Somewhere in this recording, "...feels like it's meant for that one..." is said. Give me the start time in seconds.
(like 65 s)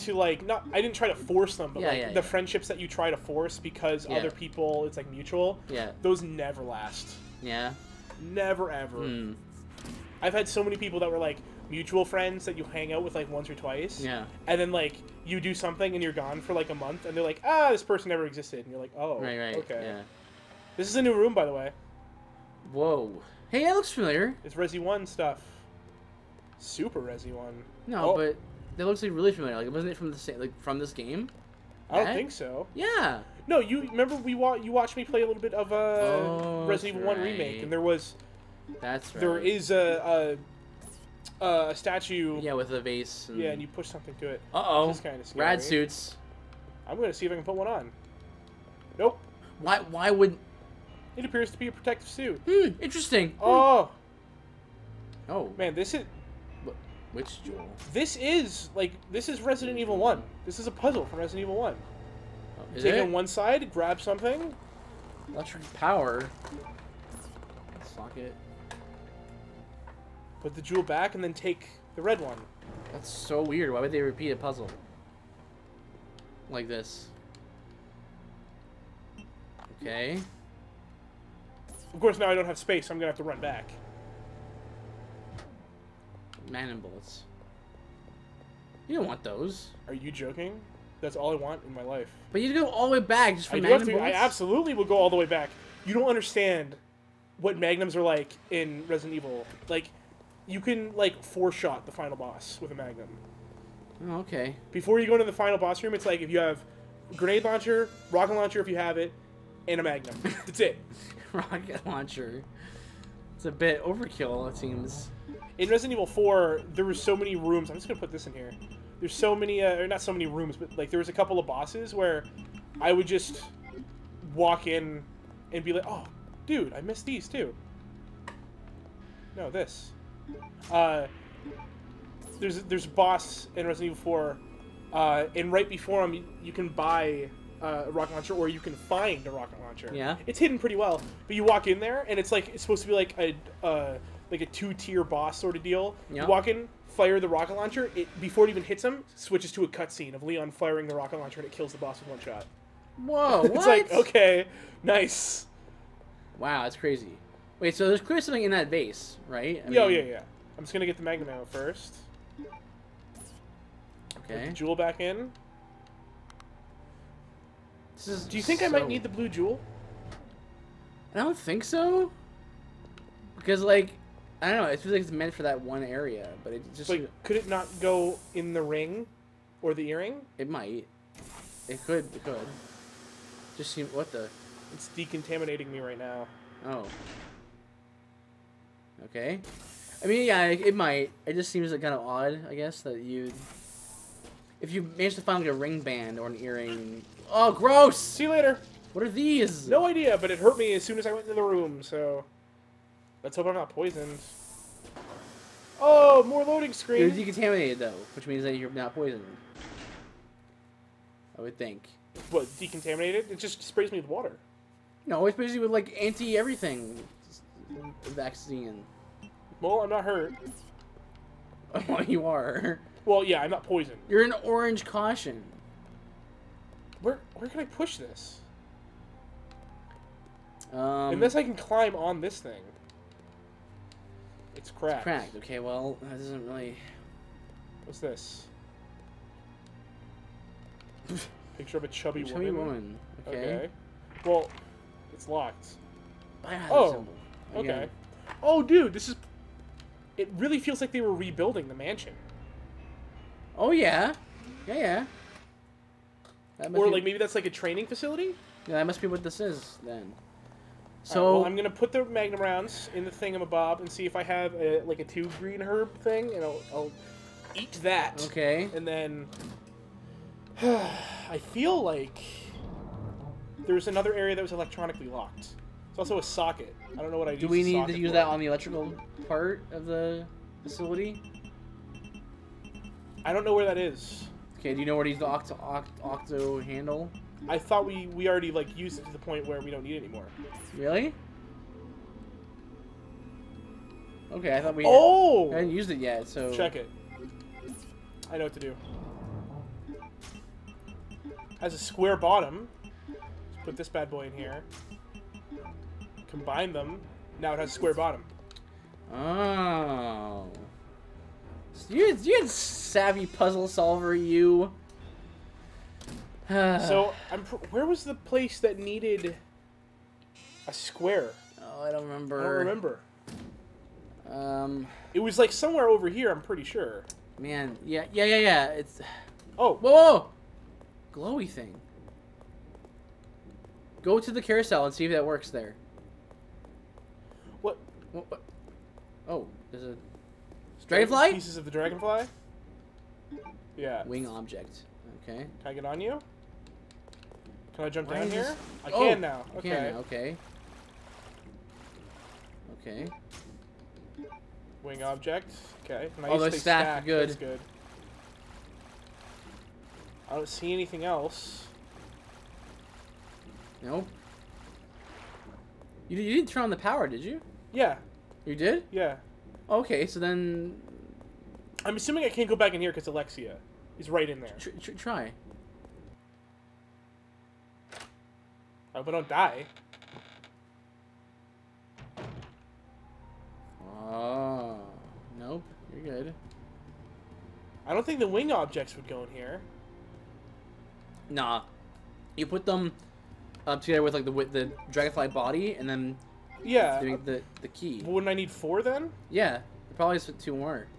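174 s.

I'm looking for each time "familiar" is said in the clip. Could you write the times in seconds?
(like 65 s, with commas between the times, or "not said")
23 s, 29 s.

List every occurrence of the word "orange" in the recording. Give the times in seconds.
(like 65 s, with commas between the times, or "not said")
224 s.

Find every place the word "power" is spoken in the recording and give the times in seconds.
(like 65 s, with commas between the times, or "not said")
65 s, 366 s.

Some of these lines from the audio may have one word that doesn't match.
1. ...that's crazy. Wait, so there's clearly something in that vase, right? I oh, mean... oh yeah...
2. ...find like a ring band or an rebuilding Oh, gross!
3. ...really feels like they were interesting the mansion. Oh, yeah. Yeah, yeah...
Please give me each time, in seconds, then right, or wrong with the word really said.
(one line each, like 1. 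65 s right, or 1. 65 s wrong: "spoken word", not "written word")
1. 156 s right
2. 195 s wrong: "earring", not "rebuilding"
3. 250 s wrong: "rebuilding", not "interesting".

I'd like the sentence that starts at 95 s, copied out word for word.
You don't understand what magnums are like in Resident Evil.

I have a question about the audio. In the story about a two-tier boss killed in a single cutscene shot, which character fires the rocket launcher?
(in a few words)
Leon.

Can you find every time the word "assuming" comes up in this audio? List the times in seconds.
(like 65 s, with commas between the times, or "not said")
371 s.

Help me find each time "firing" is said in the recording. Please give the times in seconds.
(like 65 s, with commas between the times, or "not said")
150 s.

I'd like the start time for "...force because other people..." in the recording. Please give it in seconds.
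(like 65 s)
3 s.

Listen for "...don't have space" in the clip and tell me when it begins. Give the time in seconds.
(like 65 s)
82 s.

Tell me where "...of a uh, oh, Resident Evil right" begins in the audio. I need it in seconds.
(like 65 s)
35 s.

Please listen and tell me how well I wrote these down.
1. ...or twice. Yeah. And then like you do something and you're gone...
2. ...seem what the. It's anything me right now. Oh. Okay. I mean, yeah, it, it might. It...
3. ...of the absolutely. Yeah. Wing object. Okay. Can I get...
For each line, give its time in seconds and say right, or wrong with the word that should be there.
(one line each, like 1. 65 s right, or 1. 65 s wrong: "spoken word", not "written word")
1. 13 s right
2. 183 s wrong: "decontaminating", not "anything"
3. 341 s wrong: "dragonfly", not "absolutely".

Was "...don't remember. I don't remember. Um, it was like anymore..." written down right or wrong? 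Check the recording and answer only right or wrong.
wrong.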